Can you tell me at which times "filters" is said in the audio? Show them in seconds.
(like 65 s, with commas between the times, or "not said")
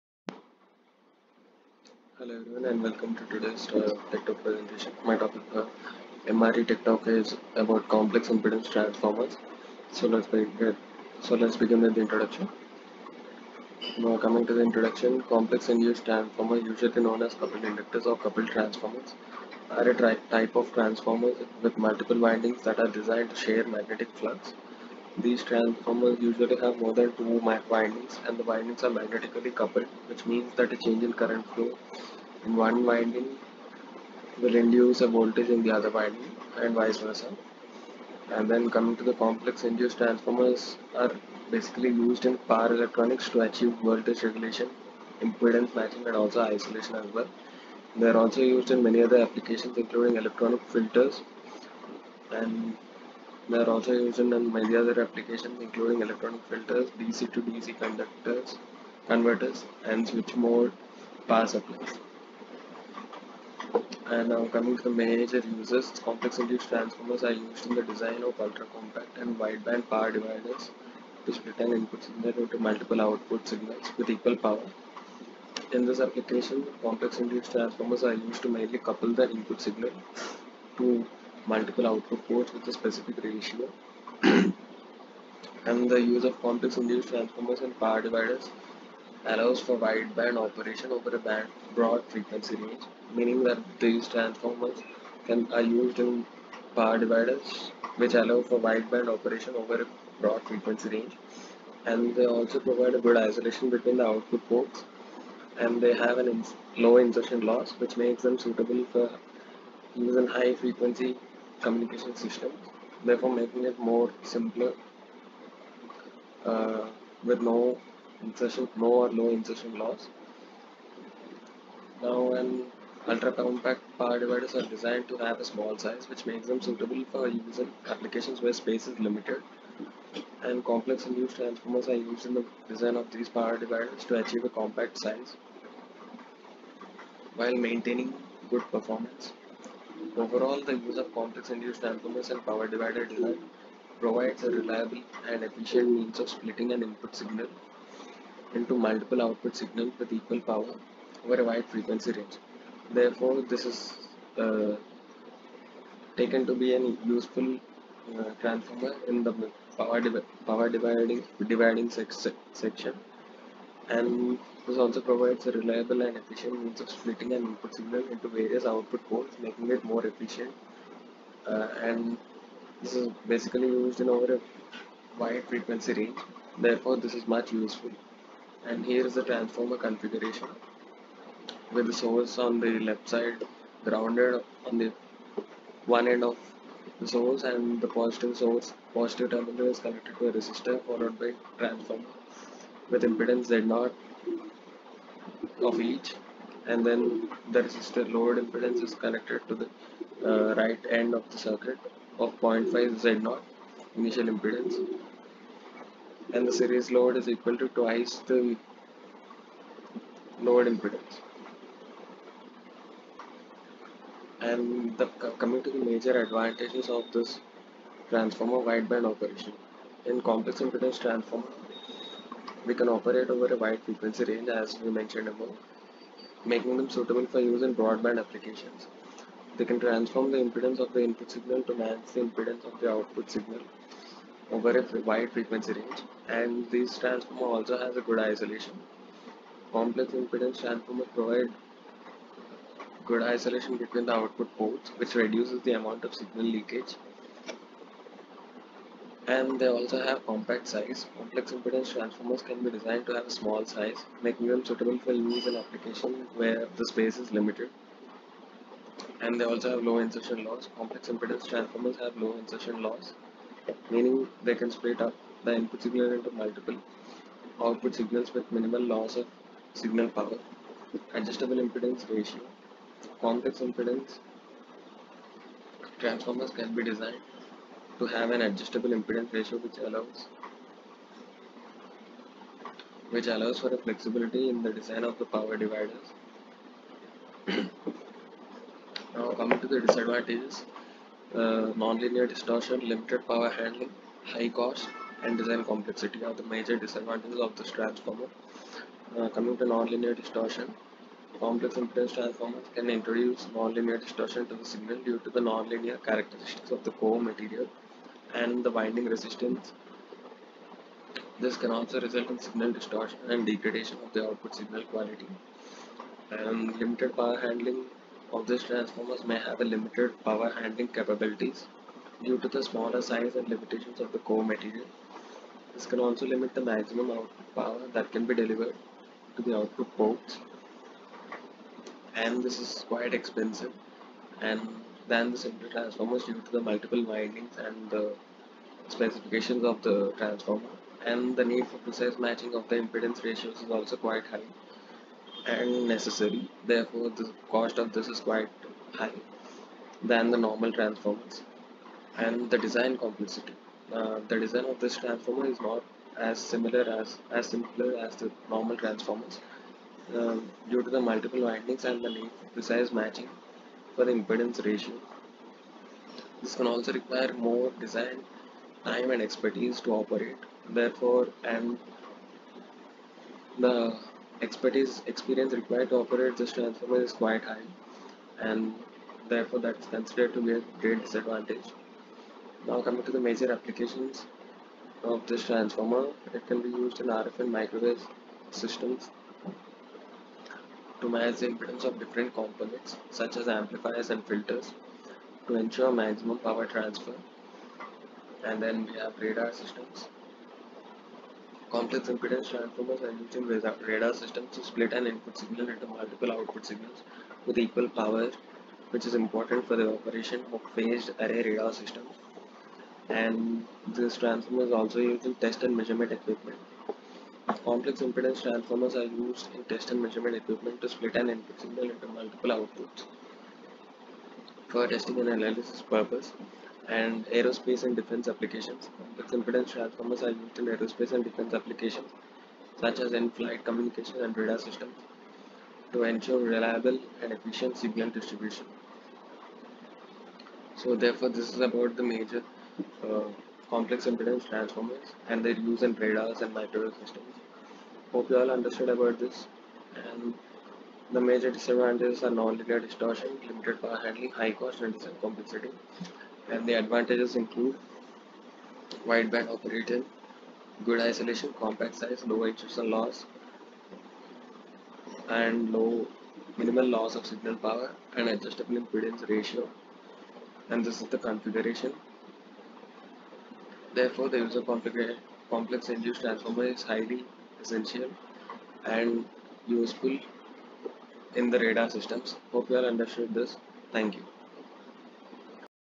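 50 s, 56 s, 394 s.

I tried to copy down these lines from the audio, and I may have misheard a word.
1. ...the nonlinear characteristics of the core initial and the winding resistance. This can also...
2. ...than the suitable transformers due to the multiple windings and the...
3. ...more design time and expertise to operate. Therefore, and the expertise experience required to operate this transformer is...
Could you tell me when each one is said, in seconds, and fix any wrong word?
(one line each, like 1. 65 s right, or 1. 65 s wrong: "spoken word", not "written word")
1. 305 s wrong: "material", not "initial"
2. 335 s wrong: "simple", not "suitable"
3. 367 s right.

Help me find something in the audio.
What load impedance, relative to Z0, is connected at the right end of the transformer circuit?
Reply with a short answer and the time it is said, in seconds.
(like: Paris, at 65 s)
0.5 Z0, at 202 s.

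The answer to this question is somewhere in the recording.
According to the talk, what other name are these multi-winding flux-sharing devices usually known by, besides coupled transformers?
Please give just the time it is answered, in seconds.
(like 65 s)
17 s.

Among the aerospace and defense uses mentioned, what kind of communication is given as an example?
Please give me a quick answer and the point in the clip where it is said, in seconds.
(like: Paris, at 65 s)
in-flight communication, at 433 s.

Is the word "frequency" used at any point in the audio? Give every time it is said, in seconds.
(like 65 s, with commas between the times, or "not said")
92 s, 100 s, 110 s, 151 s, 175 s, 223 s, 235 s.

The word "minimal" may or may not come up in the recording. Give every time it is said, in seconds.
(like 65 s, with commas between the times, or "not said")
268 s, 466 s.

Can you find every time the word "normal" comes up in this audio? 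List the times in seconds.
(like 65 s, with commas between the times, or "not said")
350 s, 358 s.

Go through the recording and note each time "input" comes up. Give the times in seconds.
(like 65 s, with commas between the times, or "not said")
71 s, 79 s, 146 s, 167 s, 231 s, 265 s, 405 s, 421 s.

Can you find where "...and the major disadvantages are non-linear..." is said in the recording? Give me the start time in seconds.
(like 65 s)
450 s.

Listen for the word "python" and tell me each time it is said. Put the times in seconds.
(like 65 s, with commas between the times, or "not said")
not said.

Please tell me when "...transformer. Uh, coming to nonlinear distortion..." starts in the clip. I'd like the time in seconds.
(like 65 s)
297 s.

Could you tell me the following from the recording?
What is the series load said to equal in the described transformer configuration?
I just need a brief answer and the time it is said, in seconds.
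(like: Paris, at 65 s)
twice the load impedance, at 207 s.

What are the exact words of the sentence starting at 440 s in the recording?
So therefore this is about the major uh, complex impedance transformers and their use in radars and microwave systems.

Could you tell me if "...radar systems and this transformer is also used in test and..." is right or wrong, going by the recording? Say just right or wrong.
right.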